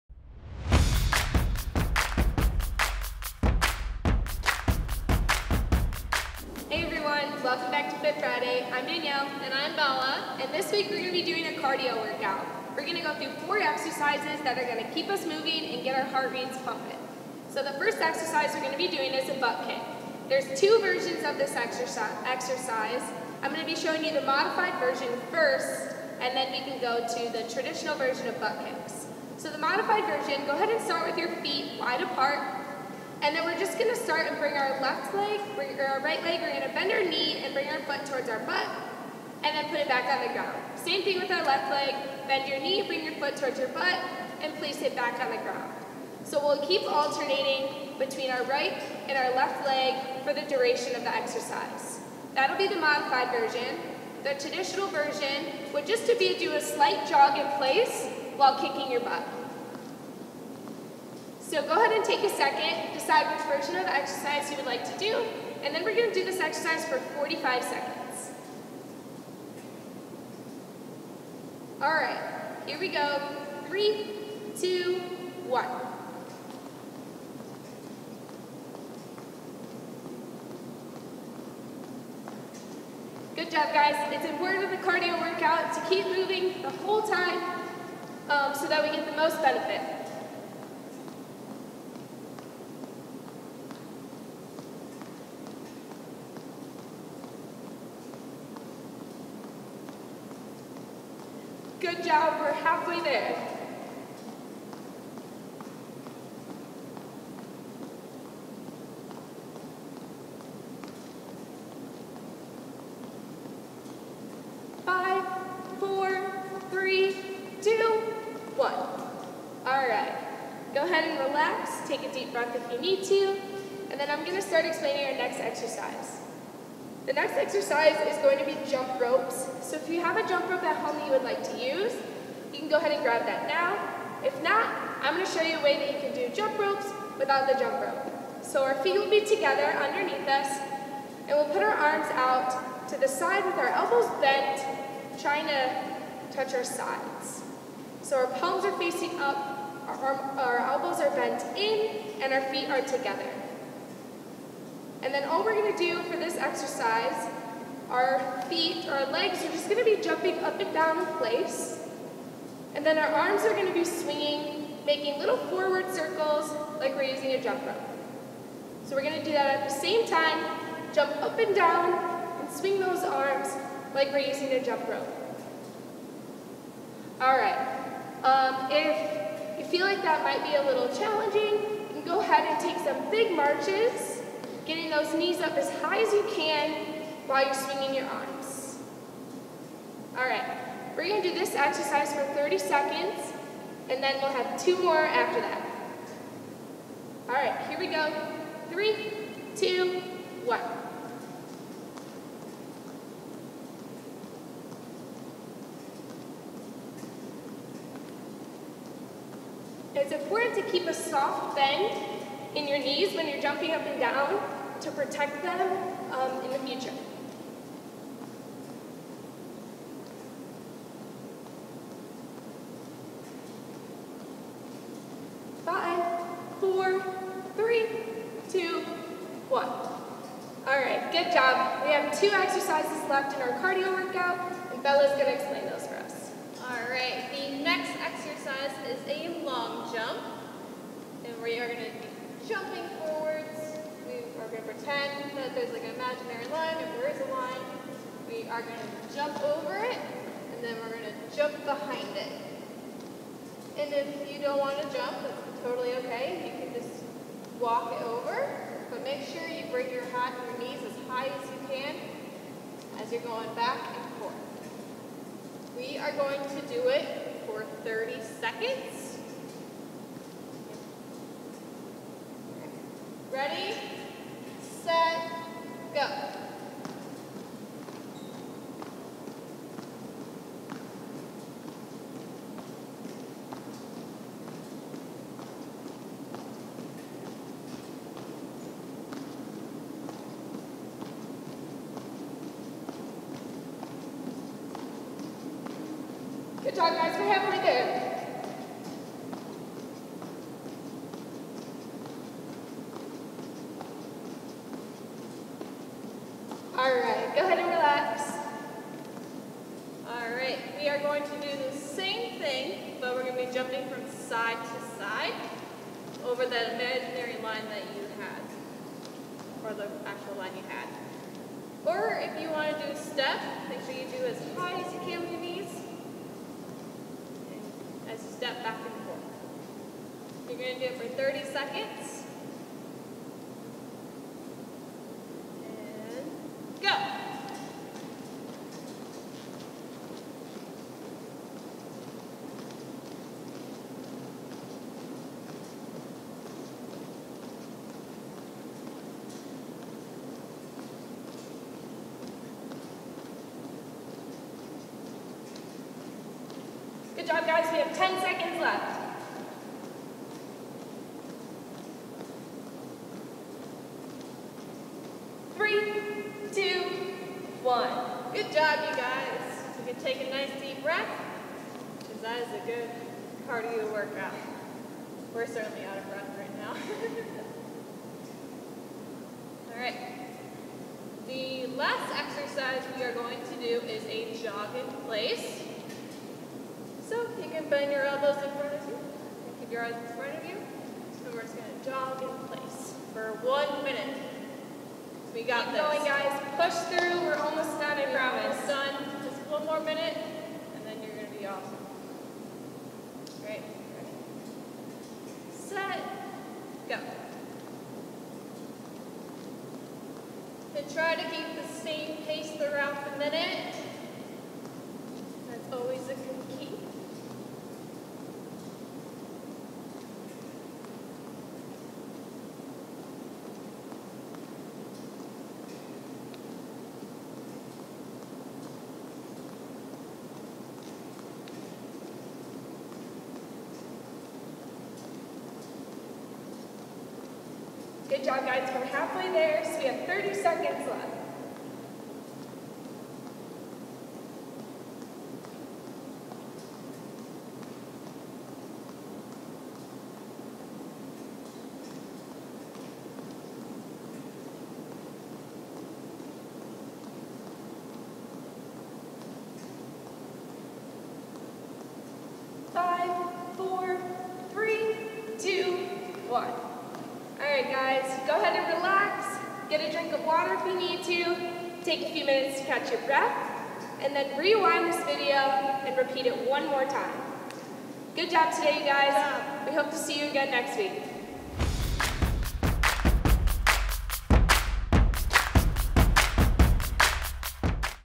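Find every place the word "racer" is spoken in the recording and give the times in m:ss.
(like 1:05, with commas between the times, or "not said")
not said.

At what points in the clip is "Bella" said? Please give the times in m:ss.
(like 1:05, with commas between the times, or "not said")
0:09, 3:54.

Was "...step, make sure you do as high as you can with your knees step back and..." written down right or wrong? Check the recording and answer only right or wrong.
right.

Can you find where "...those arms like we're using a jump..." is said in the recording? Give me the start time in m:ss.
2:52.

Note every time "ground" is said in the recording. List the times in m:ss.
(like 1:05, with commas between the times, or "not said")
0:40, 0:45.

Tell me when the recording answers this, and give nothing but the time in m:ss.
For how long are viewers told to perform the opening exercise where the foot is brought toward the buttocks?
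1:06.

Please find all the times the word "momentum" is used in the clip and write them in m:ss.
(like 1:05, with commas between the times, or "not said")
not said.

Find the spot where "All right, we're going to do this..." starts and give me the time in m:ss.
3:10.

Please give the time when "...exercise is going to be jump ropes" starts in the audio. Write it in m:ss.
2:07.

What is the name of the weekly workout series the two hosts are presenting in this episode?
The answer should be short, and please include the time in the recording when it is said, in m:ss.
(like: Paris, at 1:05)
Fit Friday, at 0:08.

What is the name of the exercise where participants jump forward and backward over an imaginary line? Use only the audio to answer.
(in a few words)
Long jump.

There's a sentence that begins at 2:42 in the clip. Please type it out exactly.
And then our arms are going to be swinging, making little forward circles like we're using a jump rope.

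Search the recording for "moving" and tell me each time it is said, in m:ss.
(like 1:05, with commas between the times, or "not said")
0:15, 1:26.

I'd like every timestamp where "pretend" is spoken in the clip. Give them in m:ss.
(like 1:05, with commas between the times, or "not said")
4:04.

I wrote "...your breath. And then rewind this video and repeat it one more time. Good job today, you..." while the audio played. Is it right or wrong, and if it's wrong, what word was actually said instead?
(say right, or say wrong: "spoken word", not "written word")
right.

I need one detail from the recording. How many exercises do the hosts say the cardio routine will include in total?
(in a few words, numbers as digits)
4.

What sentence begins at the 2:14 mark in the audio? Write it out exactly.
If not, I'm going to show you a way that you can do jump ropes without the jump rope.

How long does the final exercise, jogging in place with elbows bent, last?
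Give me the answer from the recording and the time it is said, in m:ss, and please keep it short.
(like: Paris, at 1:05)
1 minute, at 6:33.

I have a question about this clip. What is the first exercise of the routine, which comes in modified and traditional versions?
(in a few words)
Butt kick.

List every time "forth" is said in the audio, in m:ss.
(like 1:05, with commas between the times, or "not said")
4:24, 5:29.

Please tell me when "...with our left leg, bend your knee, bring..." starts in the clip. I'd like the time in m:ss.
0:41.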